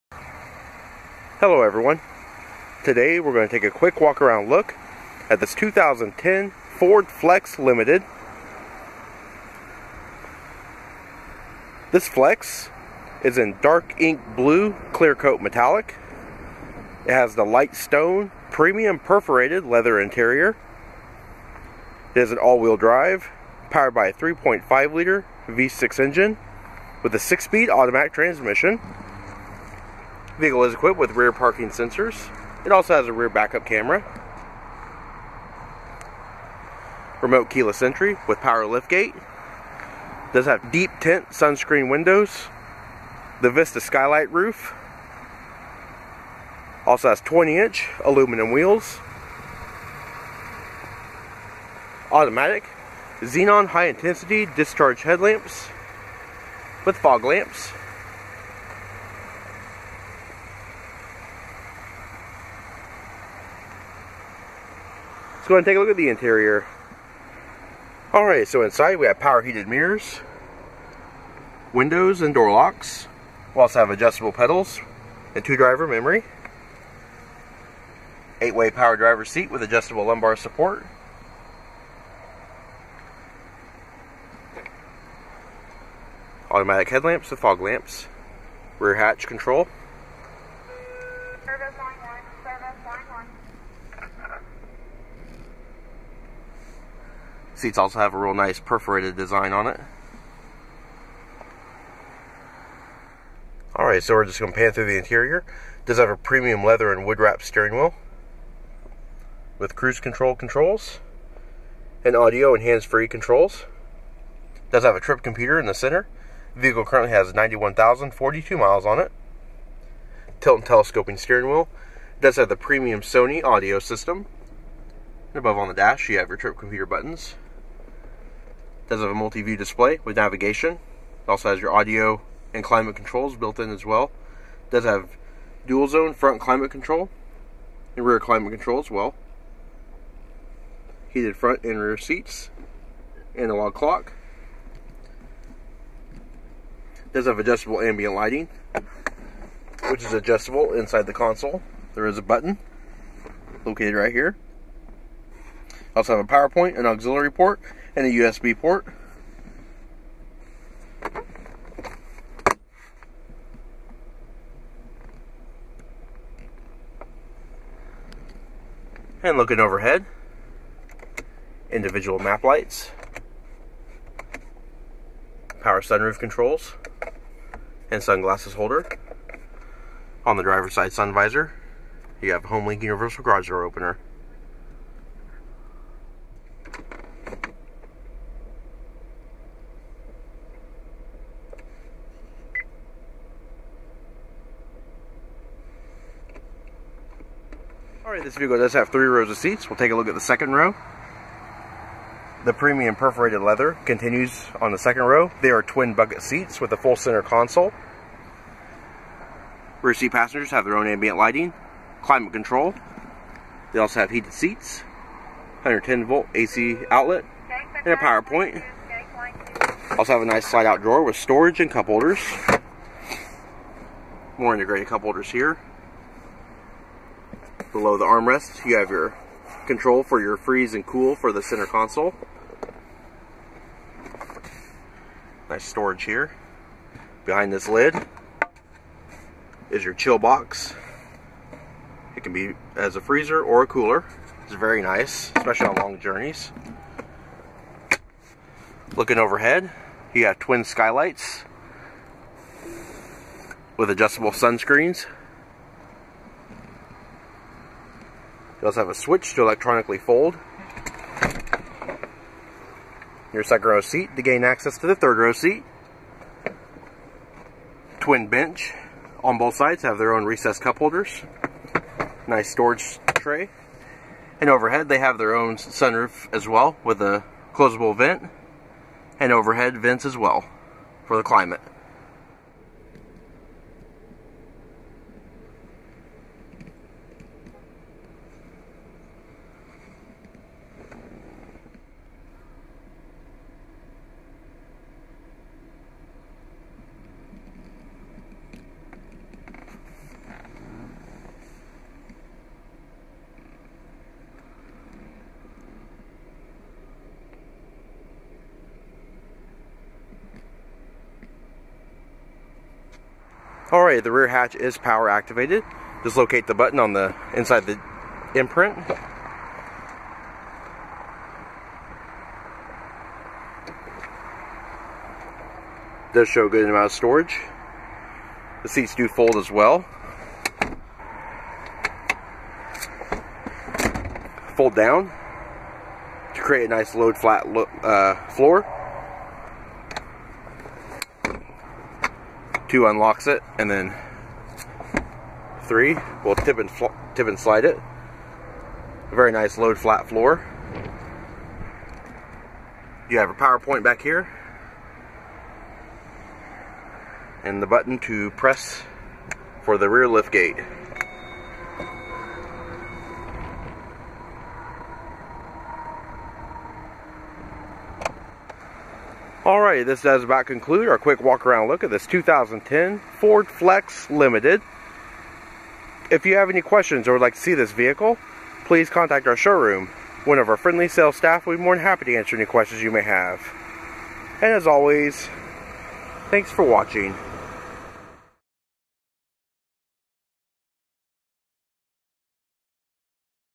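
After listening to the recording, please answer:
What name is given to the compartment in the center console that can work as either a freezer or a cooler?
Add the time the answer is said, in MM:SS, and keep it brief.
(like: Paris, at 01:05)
chill box, at 03:59.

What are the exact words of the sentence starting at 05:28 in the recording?
The seats do fold as well.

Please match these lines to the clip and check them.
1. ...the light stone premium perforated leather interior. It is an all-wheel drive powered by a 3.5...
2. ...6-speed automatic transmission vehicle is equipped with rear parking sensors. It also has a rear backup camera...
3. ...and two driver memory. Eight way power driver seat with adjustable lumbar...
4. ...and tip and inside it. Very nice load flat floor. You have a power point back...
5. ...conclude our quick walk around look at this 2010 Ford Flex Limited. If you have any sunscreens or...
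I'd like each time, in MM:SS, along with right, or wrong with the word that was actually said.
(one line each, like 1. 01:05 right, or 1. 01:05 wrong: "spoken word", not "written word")
1. 00:17 right
2. 00:27 right
3. 01:15 right
4. 05:46 wrong: "slide", not "inside"
5. 06:10 wrong: "questions", not "sunscreens".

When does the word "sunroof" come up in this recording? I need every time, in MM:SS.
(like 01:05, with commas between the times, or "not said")
02:55, 04:35.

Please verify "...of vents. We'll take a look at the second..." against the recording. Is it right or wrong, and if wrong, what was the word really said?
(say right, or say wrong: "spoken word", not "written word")
wrong: "seats", not "vents".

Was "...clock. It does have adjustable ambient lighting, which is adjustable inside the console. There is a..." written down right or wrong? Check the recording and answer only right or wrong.
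right.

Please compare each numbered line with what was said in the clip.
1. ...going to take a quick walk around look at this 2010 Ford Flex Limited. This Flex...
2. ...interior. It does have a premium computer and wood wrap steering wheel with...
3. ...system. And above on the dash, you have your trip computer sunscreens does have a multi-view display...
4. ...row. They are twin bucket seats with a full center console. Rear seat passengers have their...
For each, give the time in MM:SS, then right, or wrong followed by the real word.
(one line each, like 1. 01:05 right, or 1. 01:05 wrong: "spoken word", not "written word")
1. 00:03 right
2. 01:44 wrong: "leather", not "computer"
3. 02:03 wrong: "buttons", not "sunscreens"
4. 03:25 right.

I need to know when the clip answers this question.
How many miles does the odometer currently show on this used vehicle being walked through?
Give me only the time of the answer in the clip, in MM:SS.
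01:57.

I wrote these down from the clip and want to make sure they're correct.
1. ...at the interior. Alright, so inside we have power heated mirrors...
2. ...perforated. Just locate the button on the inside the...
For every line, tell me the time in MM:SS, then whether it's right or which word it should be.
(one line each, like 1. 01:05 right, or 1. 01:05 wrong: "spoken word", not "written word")
1. 01:05 right
2. 05:15 wrong: "activated", not "perforated".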